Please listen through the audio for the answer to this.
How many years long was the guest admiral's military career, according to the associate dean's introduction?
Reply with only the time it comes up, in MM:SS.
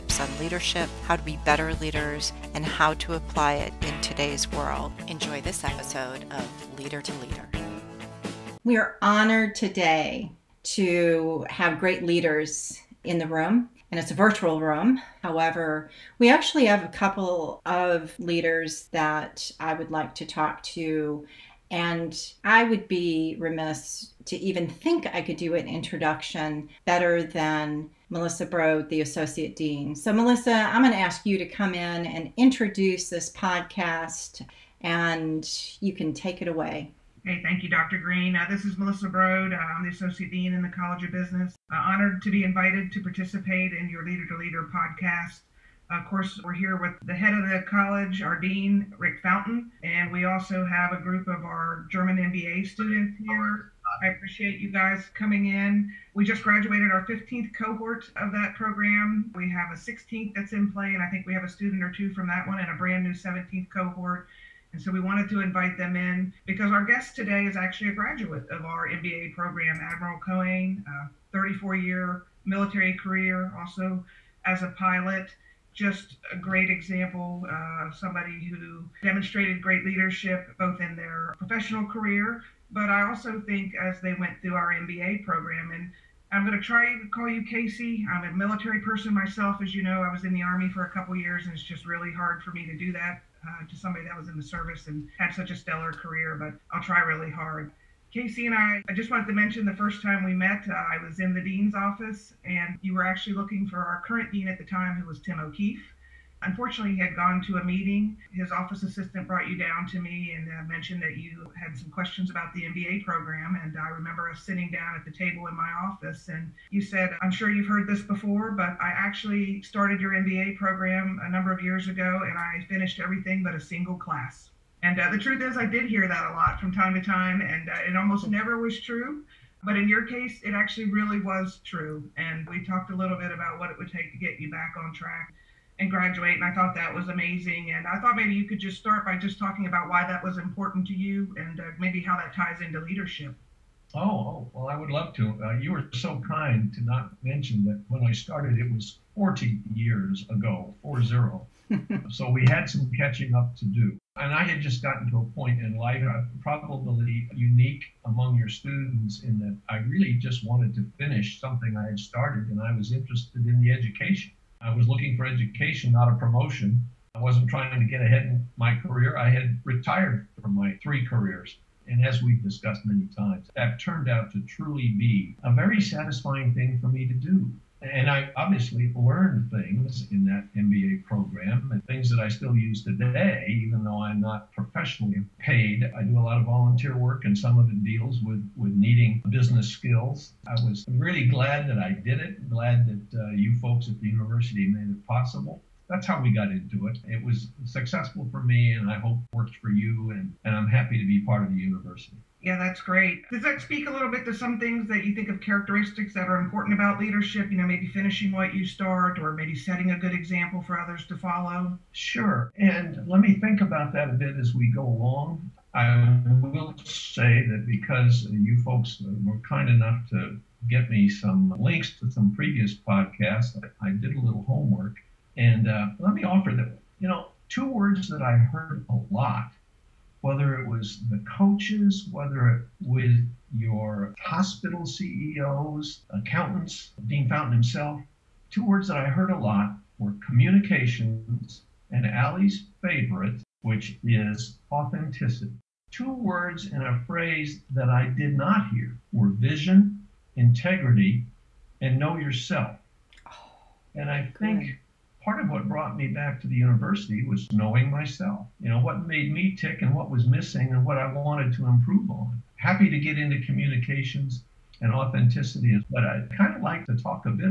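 01:11.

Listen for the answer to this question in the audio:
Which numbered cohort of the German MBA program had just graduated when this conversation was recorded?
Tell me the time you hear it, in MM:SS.
00:57.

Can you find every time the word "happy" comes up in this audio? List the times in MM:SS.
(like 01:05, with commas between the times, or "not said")
03:20, 04:22.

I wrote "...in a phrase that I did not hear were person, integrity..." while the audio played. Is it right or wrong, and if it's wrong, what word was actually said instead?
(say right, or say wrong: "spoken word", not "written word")
wrong: "vision", not "person".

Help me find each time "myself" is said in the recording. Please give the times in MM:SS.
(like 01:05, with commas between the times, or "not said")
01:29, 04:17.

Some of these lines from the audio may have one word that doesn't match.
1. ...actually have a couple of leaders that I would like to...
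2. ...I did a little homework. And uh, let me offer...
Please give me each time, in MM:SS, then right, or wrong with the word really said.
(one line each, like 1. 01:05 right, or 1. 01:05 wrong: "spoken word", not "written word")
1. 00:16 right
2. 03:43 right.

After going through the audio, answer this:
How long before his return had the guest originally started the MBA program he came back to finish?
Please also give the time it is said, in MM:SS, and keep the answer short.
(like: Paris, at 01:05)
40 years, at 02:29.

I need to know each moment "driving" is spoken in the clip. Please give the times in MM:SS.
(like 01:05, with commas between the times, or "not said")
not said.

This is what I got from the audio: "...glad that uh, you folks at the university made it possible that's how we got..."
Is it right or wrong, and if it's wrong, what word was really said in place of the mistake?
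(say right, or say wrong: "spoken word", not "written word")
right.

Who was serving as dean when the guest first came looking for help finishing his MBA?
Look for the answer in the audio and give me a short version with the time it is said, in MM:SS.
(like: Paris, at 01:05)
Tim O'Keefe, at 01:45.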